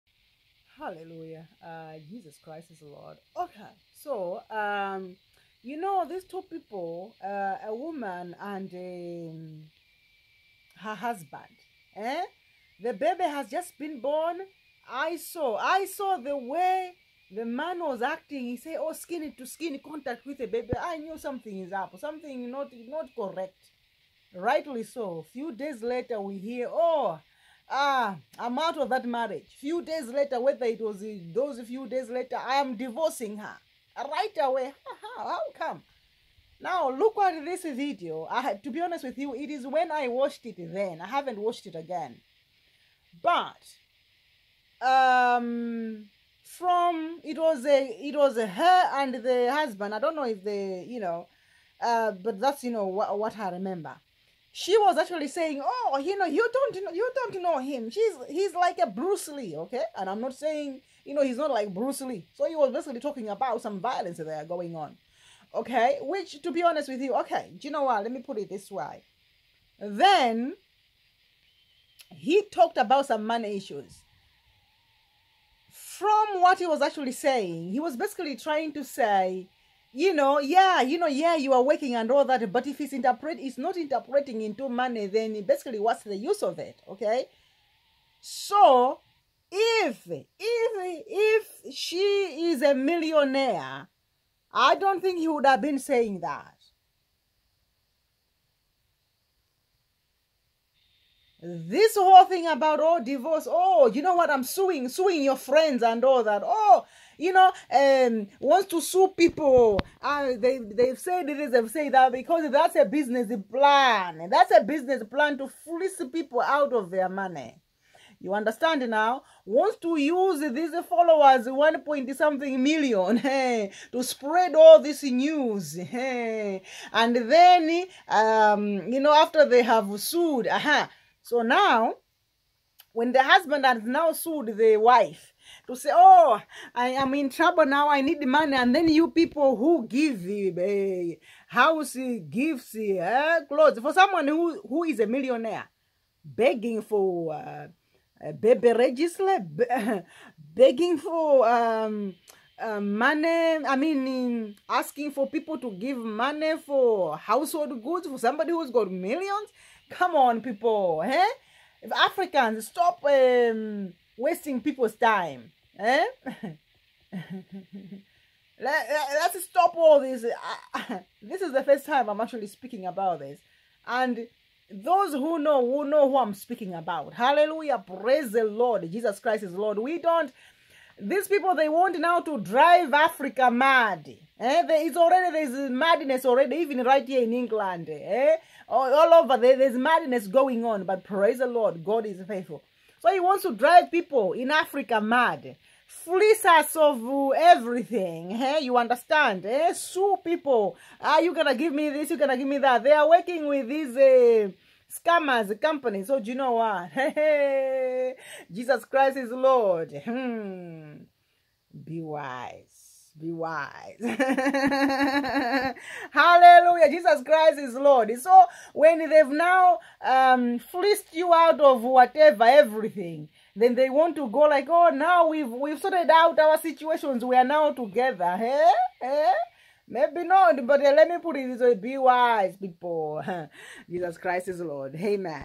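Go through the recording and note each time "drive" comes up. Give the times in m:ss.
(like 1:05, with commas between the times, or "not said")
3:02, 3:13.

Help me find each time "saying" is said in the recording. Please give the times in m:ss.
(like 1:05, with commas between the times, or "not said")
0:55, 1:00, 1:17, 1:35.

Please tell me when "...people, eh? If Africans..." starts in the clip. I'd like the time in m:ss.
2:40.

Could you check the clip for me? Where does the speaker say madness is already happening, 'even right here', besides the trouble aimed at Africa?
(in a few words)
England.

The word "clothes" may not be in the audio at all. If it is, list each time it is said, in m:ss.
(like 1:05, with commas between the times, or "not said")
2:23.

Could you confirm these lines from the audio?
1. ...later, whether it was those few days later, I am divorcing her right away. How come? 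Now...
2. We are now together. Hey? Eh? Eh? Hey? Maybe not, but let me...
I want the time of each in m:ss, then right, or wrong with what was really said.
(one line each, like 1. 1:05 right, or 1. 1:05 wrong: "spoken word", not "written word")
1. 0:30 right
2. 3:47 right.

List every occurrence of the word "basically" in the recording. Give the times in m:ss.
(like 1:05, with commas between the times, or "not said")
1:02, 1:17, 1:25.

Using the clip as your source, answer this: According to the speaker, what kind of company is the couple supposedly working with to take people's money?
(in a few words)
scammers company.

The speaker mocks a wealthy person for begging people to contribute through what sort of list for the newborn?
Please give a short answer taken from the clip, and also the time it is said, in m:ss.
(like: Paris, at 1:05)
baby register, at 2:28.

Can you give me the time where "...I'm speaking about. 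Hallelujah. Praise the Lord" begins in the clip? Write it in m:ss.
2:56.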